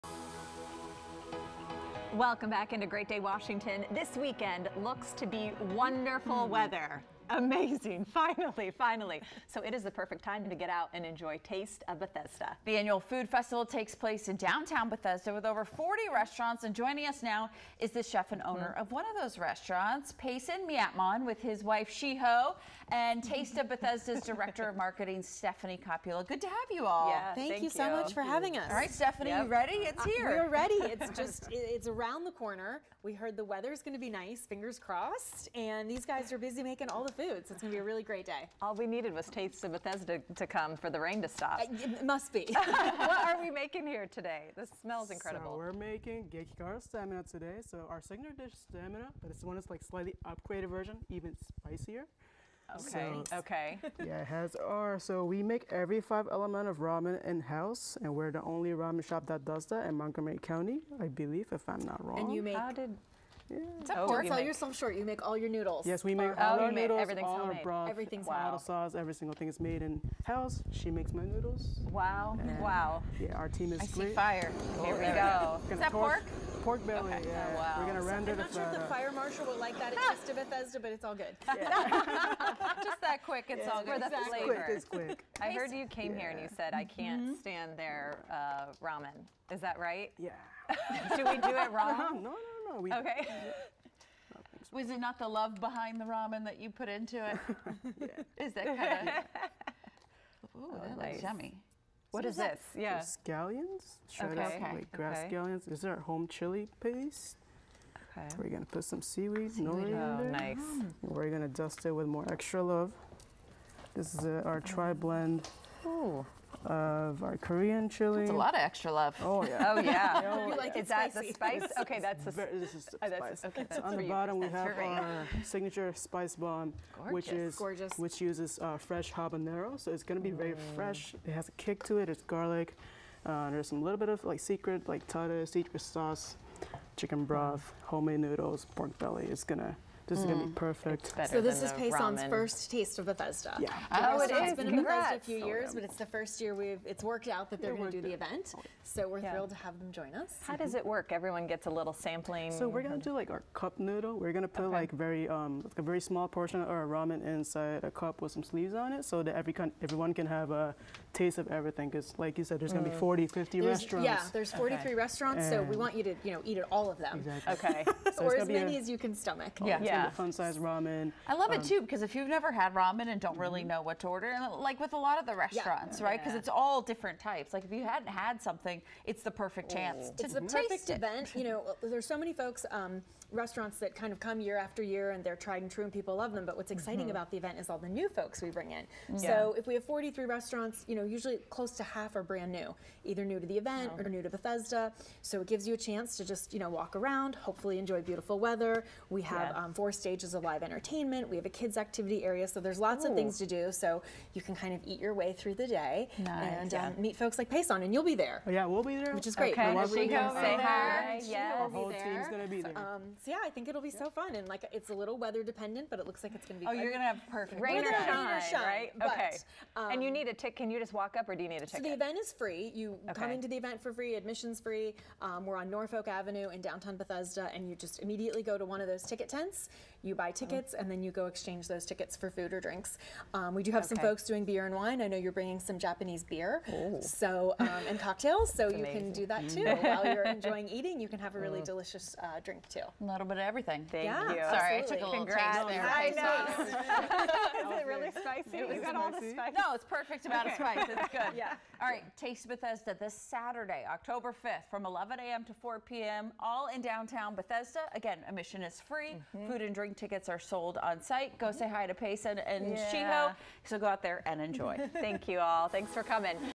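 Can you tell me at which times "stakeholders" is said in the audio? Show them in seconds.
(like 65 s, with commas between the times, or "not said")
not said.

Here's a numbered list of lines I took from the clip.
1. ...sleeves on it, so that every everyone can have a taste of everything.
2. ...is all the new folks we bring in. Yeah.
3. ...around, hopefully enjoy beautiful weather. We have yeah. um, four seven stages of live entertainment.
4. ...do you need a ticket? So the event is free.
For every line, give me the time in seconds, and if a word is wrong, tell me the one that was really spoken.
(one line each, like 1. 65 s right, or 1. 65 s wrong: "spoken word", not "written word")
1. 158 s right
2. 187 s right
3. 196 s wrong: "four", not "seven"
4. 221 s right.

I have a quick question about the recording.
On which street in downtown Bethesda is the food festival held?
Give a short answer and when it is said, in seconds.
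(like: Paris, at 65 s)
Norfolk Avenue, at 225 s.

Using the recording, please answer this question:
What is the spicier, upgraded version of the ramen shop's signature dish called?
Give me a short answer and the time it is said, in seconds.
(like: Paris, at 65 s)
Gekigara stamina, at 46 s.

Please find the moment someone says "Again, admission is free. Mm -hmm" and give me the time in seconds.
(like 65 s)
257 s.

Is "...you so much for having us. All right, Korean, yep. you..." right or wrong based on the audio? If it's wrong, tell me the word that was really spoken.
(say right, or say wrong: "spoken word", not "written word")
wrong: "Stephanie", not "Korean".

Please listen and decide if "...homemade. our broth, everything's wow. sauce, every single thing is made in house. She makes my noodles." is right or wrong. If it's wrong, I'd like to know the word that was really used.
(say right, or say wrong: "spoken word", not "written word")
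right.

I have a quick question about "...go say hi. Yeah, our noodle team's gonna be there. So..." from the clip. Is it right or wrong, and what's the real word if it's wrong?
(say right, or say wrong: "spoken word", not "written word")
wrong: "whole", not "noodle".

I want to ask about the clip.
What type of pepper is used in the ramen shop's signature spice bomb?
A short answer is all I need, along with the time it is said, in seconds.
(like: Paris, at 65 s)
Habanero, at 129 s.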